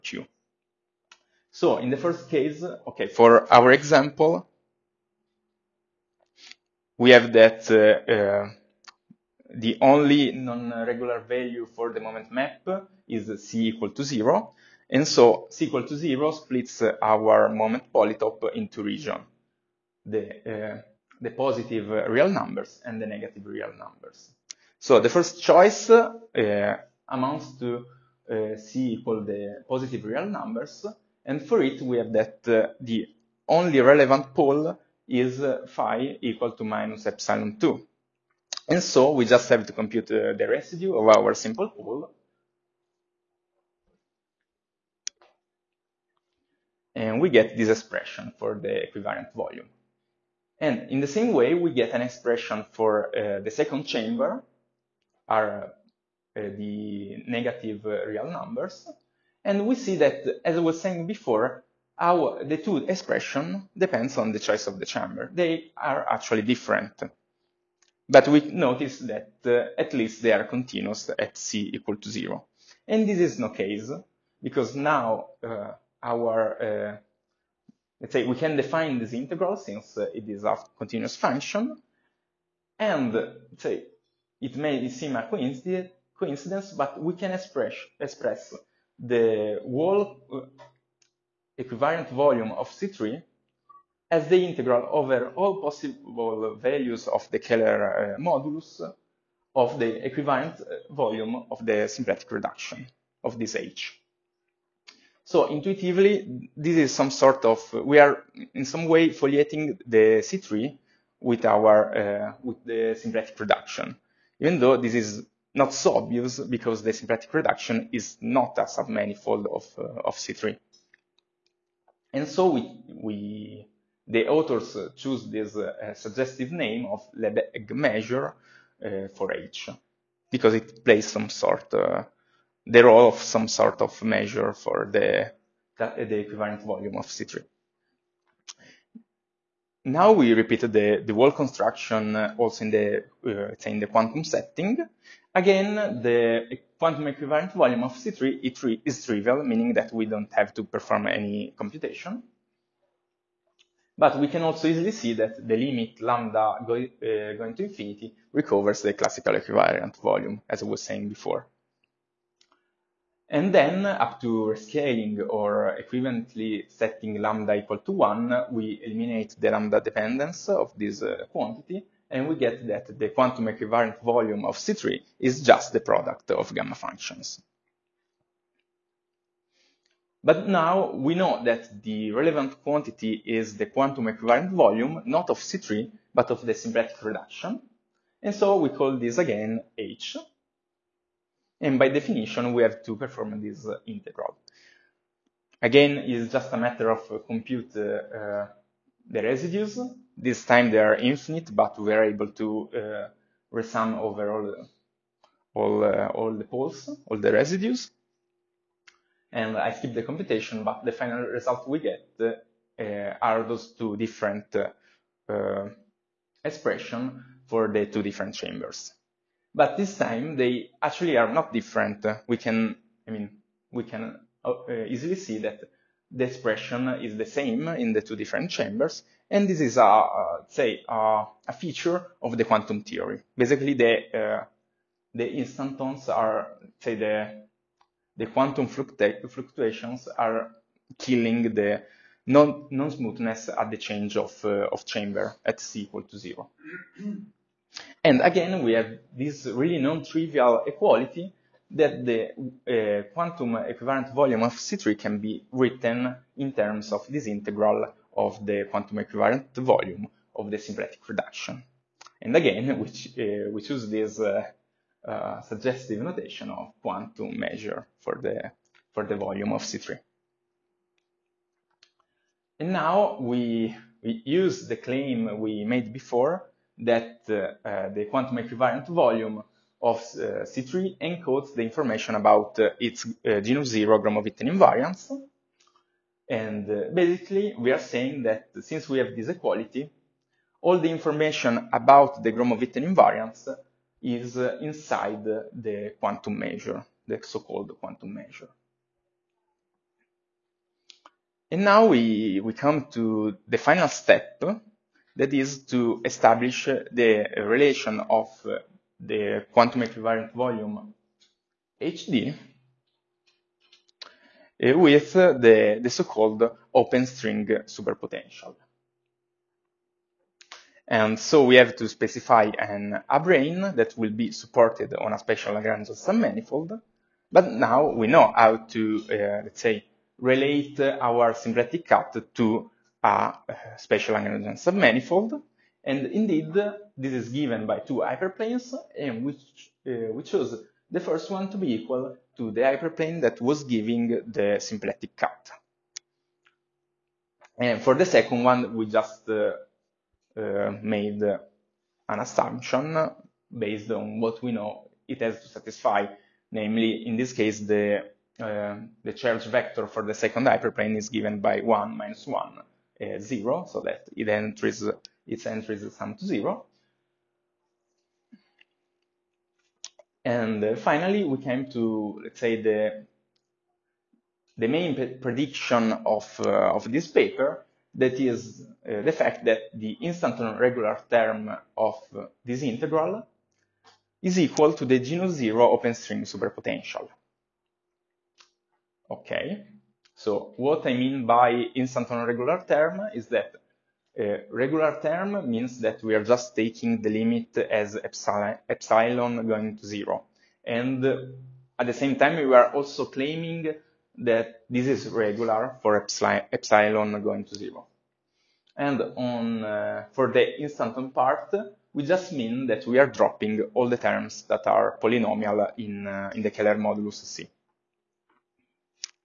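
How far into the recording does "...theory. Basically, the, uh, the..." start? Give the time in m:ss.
3:52.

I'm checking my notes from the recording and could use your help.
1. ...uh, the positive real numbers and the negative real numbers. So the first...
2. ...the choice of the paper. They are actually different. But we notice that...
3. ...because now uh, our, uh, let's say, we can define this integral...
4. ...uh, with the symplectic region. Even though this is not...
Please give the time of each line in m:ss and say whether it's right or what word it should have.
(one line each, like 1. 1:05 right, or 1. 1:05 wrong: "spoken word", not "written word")
1. 0:20 right
2. 1:04 wrong: "chamber", not "paper"
3. 1:14 right
4. 1:51 wrong: "reduction", not "region".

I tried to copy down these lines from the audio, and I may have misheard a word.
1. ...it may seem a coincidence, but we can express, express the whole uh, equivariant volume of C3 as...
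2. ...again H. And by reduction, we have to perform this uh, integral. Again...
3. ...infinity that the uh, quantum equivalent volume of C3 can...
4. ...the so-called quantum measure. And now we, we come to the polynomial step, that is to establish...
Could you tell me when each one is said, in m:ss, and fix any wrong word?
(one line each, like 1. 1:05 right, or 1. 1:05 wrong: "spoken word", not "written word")
1. 1:24 right
2. 3:09 wrong: "definition", not "reduction"
3. 4:10 wrong: "equality", not "infinity"
4. 4:57 wrong: "final", not "polynomial".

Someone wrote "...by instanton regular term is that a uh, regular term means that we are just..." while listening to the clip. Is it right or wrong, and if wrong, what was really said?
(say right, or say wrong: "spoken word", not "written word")
right.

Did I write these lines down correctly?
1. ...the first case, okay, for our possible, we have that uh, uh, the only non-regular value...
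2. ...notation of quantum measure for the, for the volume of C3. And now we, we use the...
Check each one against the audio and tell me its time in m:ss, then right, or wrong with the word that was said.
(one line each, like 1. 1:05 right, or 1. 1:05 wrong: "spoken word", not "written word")
1. 0:01 wrong: "example", not "possible"
2. 4:26 right.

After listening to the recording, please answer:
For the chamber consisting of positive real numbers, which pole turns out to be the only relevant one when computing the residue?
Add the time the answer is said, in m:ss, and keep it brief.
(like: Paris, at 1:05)
phi = -epsilon 2, at 0:35.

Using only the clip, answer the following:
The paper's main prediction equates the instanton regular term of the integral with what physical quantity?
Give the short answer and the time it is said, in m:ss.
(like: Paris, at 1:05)
genus zero open string superpotential, at 6:24.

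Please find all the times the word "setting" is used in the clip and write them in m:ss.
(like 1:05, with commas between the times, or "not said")
2:24, 2:46.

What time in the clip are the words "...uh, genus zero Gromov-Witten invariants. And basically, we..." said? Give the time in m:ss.
4:43.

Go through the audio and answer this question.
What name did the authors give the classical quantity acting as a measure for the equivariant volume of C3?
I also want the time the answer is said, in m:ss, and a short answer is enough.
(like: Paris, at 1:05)
Lebesgue measure, at 2:07.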